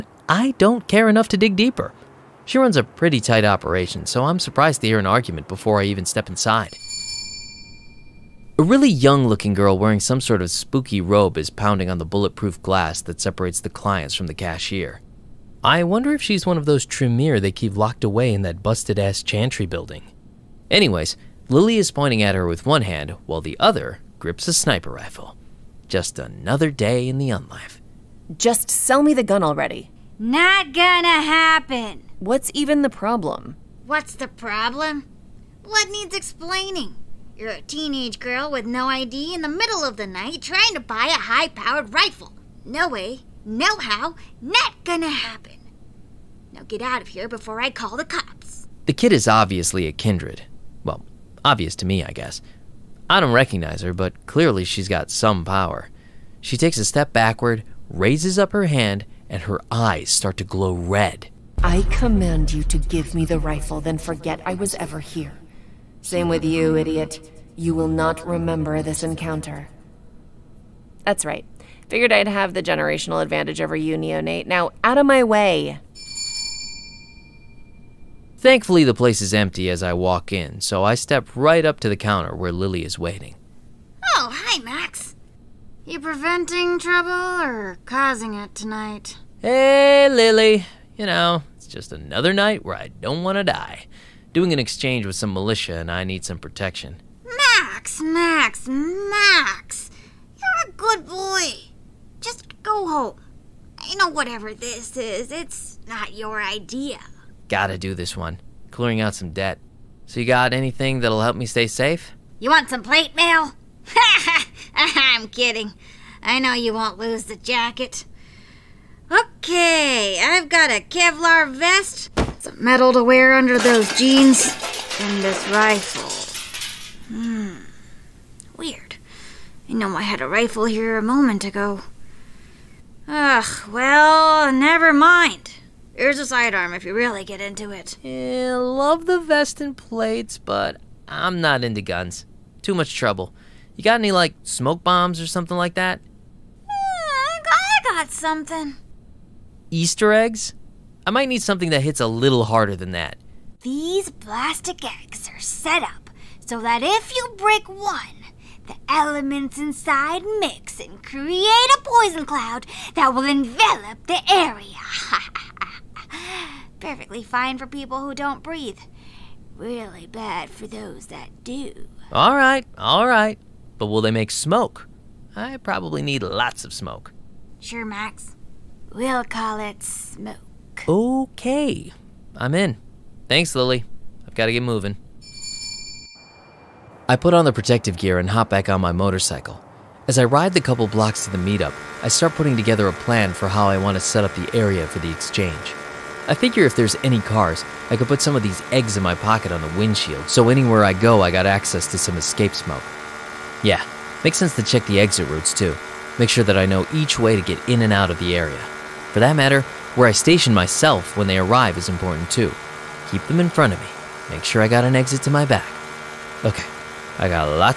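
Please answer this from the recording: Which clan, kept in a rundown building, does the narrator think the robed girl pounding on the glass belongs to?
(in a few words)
Tremere.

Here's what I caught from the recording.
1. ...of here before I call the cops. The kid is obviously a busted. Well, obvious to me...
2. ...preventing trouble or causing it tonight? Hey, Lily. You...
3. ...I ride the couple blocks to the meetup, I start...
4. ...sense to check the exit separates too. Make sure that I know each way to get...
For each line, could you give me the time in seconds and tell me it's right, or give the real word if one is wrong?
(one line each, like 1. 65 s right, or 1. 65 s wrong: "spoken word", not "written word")
1. 47 s wrong: "kindred", not "busted"
2. 86 s right
3. 190 s right
4. 204 s wrong: "routes", not "separates".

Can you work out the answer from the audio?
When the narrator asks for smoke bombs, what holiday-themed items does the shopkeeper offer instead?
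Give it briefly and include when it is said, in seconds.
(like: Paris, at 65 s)
Easter eggs, at 149 s.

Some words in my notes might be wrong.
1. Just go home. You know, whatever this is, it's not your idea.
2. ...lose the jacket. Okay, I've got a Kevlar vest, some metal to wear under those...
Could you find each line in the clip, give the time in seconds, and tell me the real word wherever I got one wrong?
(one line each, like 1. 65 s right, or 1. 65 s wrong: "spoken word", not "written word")
1. 102 s right
2. 116 s right.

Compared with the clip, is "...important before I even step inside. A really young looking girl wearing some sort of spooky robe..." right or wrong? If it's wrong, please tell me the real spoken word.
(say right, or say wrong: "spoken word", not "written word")
wrong: "argument", not "important".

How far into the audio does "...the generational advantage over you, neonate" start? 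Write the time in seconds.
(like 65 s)
72 s.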